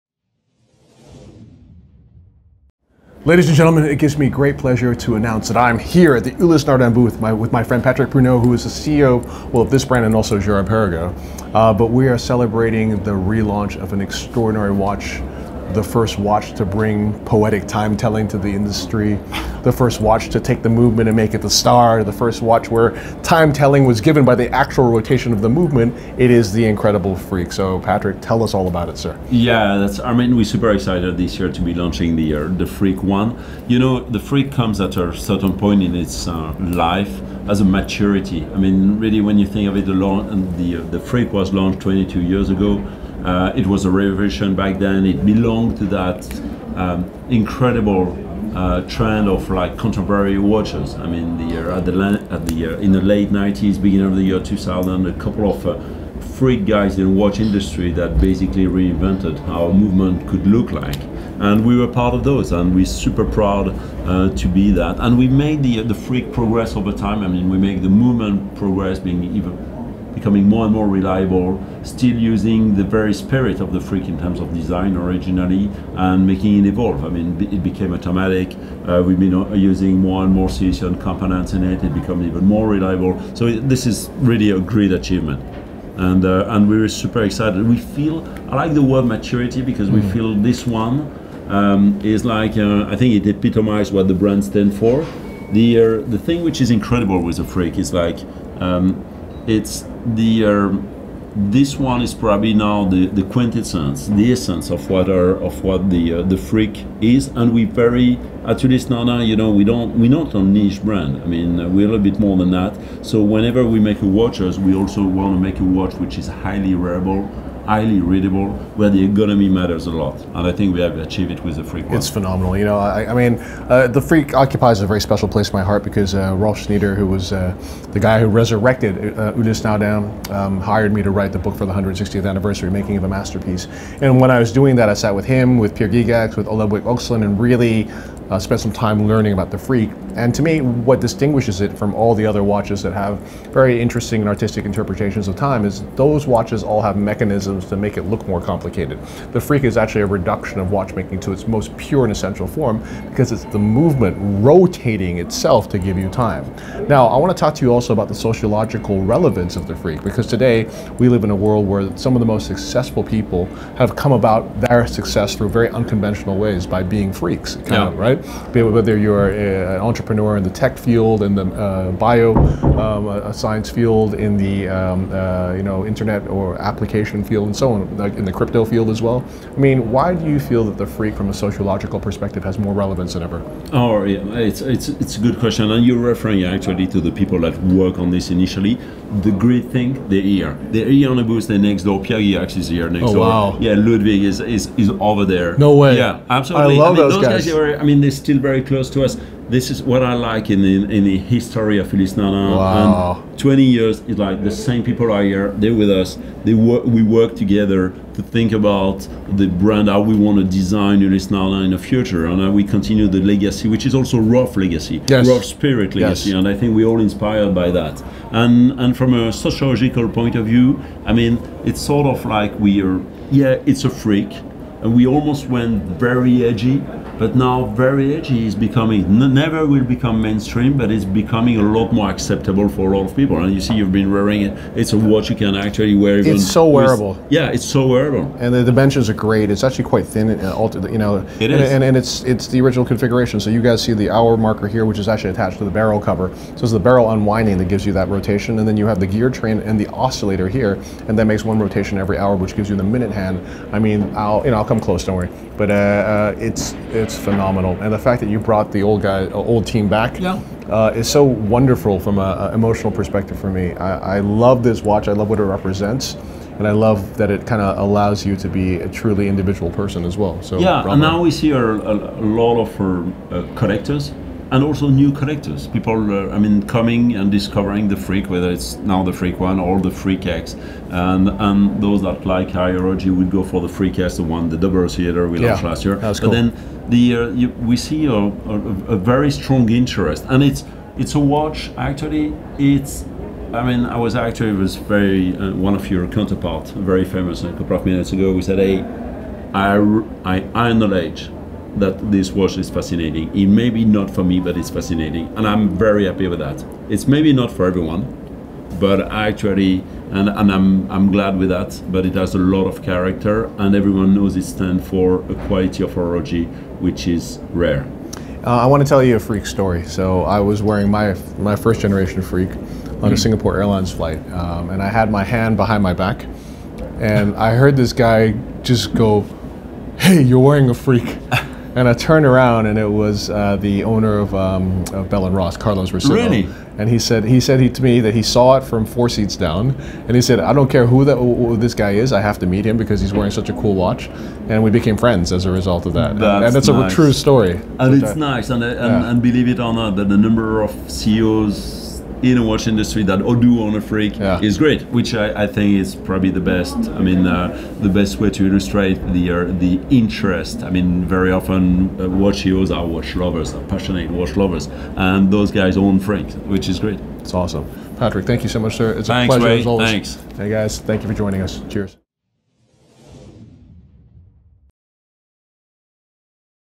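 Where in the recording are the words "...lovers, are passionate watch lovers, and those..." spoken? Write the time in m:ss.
6:03.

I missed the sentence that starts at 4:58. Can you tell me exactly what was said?
We said, "Hey, I I acknowledge that this watch is fascinating.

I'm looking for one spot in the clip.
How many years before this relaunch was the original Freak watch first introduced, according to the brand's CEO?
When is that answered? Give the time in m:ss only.
0:41.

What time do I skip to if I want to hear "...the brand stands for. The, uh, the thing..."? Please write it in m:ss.
1:34.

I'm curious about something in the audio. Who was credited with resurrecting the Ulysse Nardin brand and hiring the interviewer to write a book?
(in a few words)
Rolf Schneider.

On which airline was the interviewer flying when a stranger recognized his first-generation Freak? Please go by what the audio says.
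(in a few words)
Singapore Airlines.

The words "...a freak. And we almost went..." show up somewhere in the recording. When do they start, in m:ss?
3:43.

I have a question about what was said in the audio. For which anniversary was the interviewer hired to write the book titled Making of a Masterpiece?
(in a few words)
160th.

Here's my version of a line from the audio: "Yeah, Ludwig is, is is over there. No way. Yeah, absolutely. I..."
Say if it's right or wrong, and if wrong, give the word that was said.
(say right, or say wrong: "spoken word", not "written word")
right.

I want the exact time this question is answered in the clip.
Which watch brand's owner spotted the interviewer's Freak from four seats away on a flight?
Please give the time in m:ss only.
5:35.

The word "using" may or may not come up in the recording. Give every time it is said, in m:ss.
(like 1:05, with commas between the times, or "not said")
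1:12, 1:19.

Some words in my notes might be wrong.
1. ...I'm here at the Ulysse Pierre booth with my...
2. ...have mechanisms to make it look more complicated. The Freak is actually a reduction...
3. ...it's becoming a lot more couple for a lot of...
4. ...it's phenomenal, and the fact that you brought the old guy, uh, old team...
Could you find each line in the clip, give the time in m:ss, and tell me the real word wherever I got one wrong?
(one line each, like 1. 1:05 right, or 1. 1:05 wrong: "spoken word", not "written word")
1. 0:05 wrong: "Nardin", not "Pierre"
2. 2:26 right
3. 3:50 wrong: "acceptable", not "couple"
4. 4:16 right.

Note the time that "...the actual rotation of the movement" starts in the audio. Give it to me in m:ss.
0:24.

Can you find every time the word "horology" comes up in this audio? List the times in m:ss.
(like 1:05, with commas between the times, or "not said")
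4:42, 5:15.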